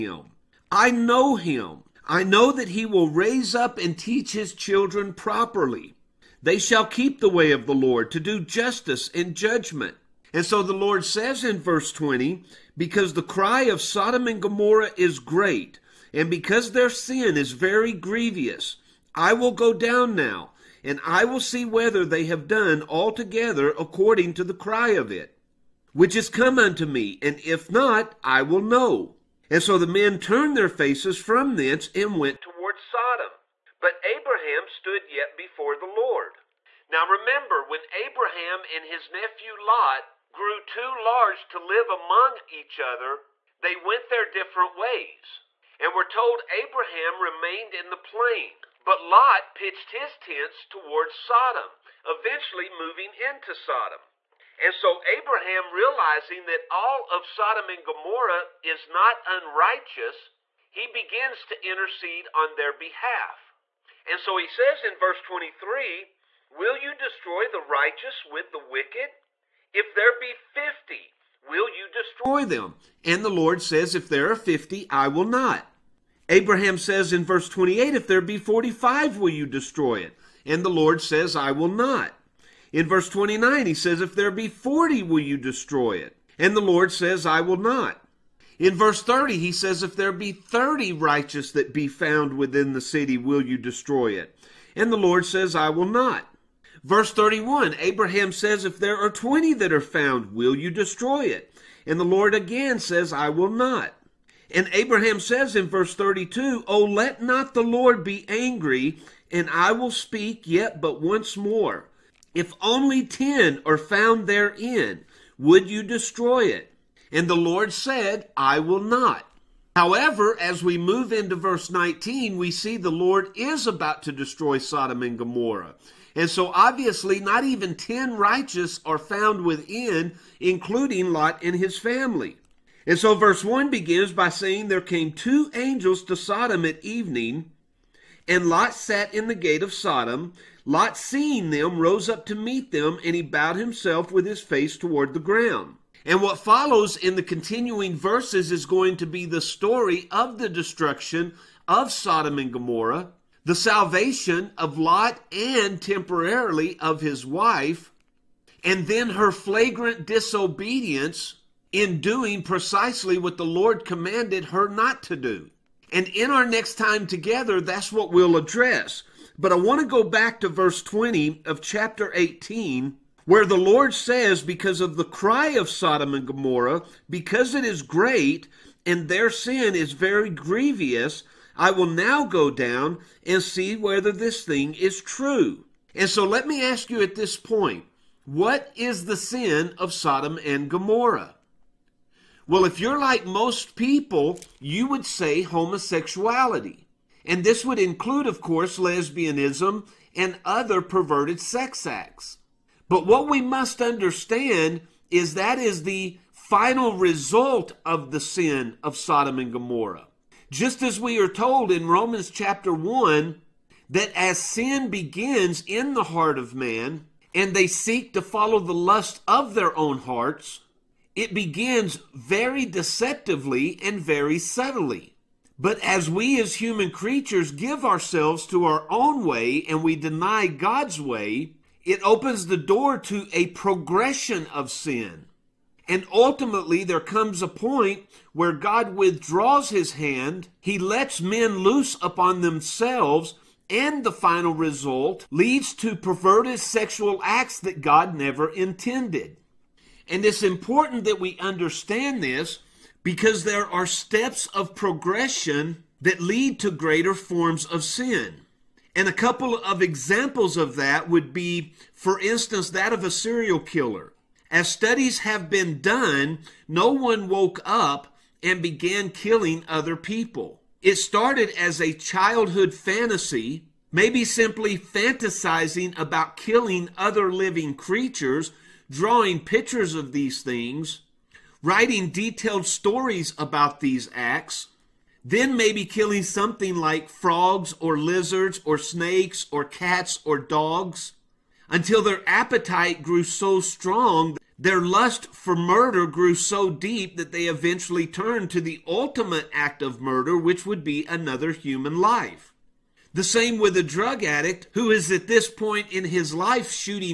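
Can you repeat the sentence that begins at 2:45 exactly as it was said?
And in our next time together, that's what we'll address.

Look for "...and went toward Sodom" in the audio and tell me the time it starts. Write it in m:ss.
0:31.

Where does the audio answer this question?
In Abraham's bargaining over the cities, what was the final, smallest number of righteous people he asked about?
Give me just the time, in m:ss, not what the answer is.
1:53.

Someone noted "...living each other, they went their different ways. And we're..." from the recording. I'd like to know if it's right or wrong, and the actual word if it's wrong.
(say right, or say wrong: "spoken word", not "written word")
wrong: "among", not "living".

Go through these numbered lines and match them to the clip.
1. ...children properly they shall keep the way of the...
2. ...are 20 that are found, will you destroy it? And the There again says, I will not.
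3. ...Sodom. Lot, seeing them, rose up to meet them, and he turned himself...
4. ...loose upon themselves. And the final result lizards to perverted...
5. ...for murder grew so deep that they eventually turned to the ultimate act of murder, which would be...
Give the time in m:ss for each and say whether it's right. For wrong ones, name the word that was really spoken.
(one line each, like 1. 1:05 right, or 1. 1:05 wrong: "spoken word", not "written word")
1. 0:04 right
2. 1:38 wrong: "Lord", not "There"
3. 2:19 wrong: "bowed", not "turned"
4. 4:01 wrong: "leads", not "lizards"
5. 4:55 right.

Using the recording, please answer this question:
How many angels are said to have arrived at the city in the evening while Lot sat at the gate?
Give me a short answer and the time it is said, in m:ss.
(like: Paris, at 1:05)
2, at 2:15.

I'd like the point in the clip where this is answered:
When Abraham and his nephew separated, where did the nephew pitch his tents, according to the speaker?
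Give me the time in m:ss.
0:50.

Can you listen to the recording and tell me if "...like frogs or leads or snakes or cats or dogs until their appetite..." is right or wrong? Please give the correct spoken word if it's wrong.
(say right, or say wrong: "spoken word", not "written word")
wrong: "lizards", not "leads".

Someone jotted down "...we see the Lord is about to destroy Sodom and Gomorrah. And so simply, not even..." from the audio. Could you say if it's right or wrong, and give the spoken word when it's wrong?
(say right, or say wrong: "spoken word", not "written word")
wrong: "obviously", not "simply".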